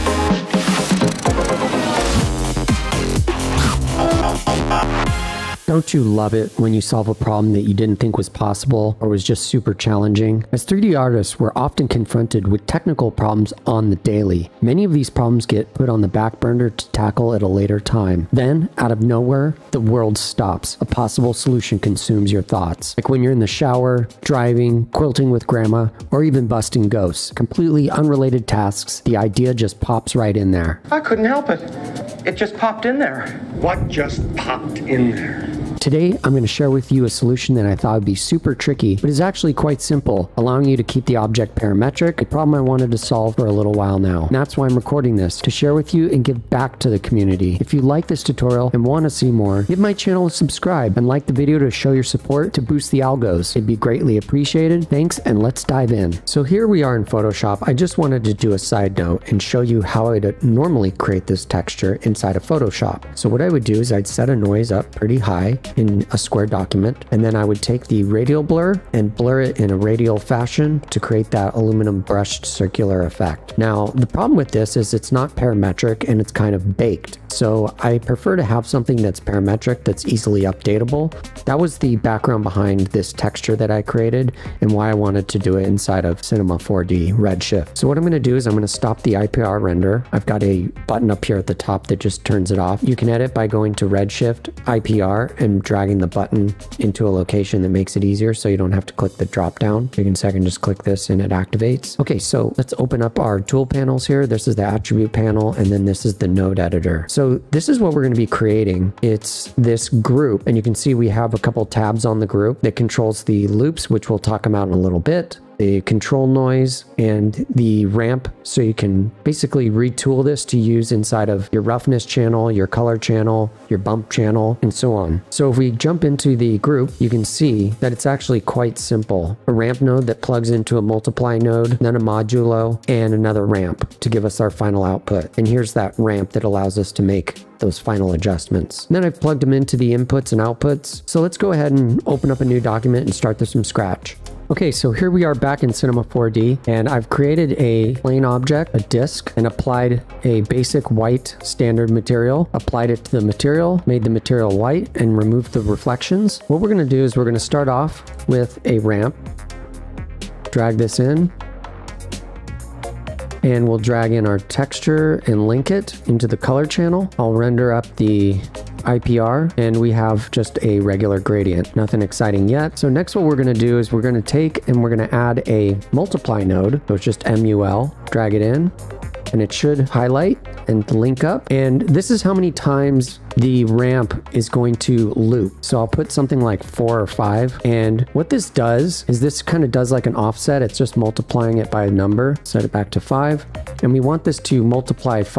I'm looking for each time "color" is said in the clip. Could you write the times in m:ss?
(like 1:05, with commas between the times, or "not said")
2:02, 2:46.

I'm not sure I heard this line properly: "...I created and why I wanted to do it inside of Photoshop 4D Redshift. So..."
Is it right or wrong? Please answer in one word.
wrong.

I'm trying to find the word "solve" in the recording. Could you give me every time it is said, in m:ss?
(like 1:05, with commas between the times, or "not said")
0:06, 0:42.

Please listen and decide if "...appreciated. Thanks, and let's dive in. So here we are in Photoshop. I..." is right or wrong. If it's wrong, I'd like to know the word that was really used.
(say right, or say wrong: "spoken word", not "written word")
right.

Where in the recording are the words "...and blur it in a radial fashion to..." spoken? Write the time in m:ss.
1:08.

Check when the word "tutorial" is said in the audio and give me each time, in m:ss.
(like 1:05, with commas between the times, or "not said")
0:48.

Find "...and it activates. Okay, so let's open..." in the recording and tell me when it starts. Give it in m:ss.
1:41.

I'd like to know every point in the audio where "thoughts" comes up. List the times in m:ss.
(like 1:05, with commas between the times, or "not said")
0:22, 0:37.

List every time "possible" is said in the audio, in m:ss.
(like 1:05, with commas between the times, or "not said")
0:08, 0:20.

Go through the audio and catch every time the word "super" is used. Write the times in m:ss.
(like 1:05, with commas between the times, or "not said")
0:09, 0:38.